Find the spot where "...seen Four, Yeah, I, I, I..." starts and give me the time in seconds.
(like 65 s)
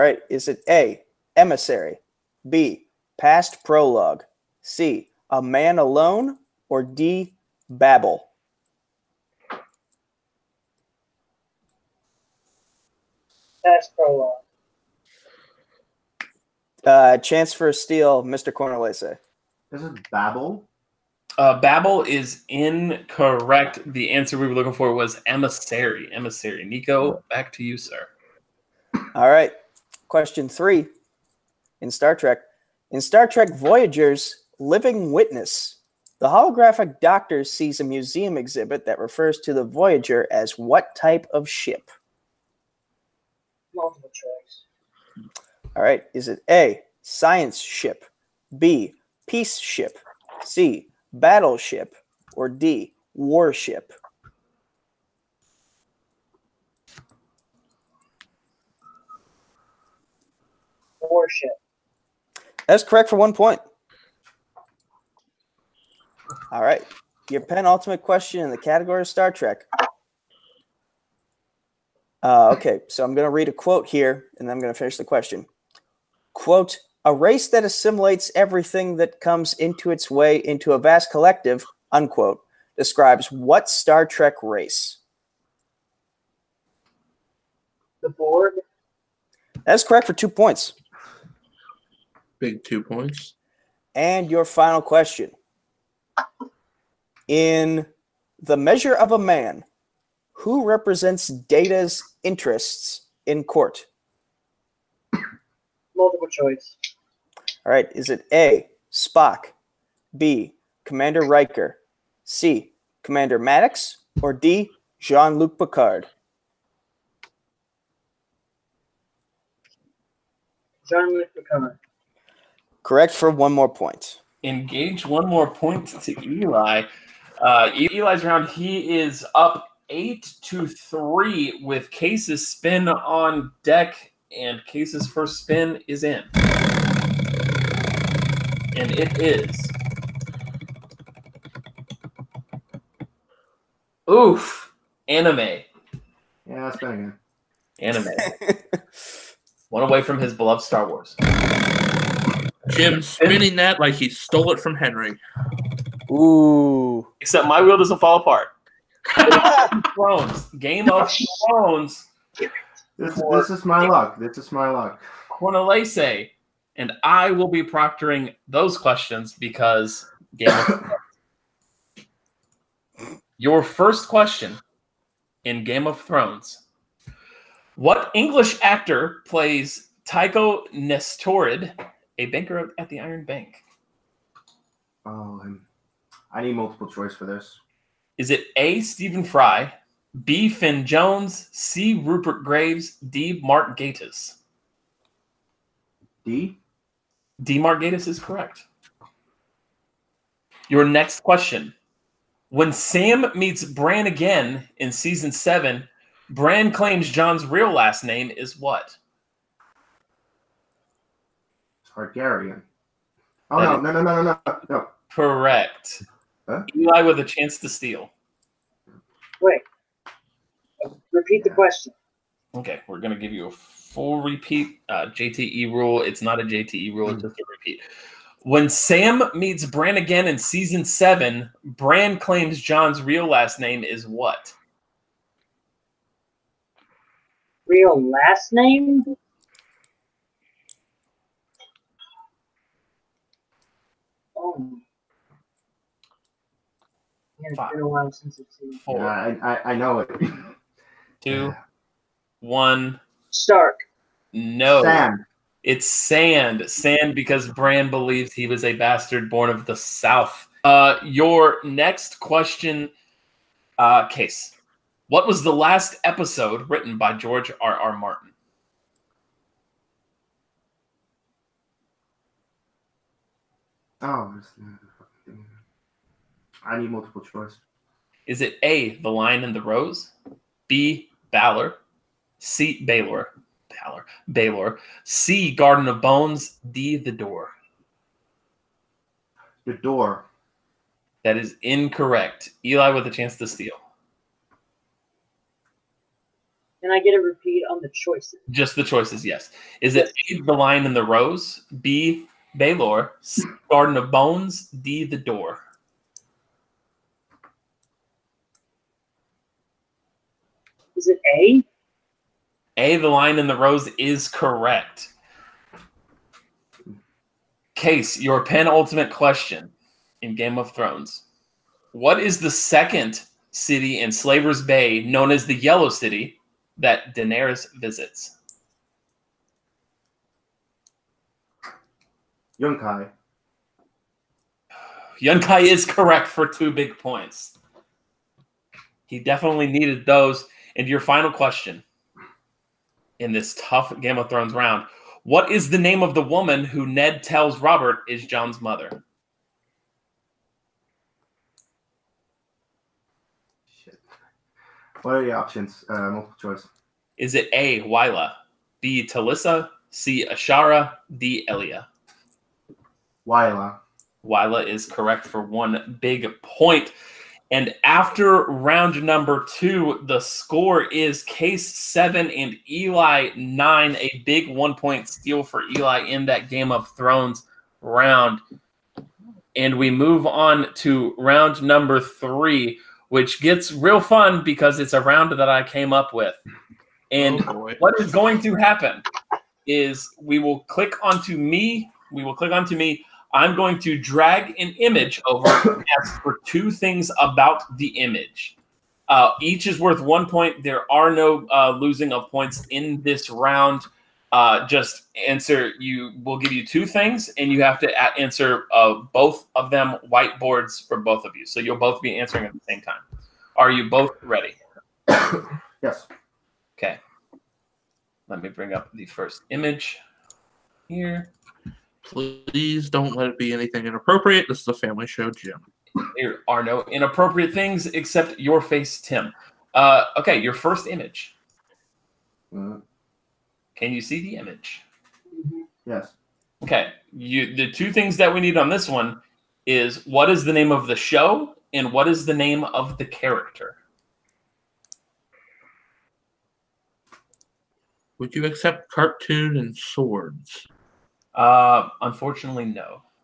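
248 s.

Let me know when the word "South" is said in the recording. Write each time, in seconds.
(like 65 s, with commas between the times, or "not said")
259 s.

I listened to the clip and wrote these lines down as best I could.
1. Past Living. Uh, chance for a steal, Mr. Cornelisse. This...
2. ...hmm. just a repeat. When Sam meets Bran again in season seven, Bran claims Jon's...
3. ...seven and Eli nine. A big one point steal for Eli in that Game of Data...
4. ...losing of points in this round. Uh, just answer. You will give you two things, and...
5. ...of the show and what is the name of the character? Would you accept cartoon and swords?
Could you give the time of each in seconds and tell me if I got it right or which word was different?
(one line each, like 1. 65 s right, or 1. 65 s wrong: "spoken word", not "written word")
1. 13 s wrong: "Prologue", not "Living"
2. 227 s right
3. 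371 s wrong: "Thrones", not "Data"
4. 401 s right
5. 440 s right.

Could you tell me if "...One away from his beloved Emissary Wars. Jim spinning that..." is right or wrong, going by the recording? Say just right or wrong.
wrong.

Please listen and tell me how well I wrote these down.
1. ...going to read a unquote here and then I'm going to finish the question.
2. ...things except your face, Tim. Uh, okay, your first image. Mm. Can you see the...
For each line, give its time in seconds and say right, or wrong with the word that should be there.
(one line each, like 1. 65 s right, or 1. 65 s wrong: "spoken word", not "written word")
1. 73 s wrong: "quote", not "unquote"
2. 427 s right.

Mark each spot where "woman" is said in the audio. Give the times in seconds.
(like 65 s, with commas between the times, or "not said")
346 s.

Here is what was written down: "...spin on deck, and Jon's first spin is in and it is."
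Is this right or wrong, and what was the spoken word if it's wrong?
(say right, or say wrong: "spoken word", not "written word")
wrong: "Kees", not "Jon".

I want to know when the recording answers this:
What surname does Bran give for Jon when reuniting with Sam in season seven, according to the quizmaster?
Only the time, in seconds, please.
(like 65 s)
255 s.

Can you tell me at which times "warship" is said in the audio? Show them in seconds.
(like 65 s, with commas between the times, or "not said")
53 s, 61 s.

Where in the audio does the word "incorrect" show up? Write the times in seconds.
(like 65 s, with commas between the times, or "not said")
22 s, 291 s.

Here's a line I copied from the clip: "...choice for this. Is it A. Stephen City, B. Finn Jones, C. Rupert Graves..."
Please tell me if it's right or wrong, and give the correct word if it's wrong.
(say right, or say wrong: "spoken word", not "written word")
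wrong: "Fry", not "City".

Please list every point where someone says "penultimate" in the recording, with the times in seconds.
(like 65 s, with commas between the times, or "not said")
67 s, 318 s.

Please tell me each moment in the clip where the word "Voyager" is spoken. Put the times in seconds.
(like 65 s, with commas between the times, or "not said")
33 s, 39 s.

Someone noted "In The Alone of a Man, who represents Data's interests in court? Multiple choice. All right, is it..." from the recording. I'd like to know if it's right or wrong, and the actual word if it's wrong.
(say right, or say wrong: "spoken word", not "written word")
wrong: "Measure", not "Alone".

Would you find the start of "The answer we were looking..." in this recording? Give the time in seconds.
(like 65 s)
23 s.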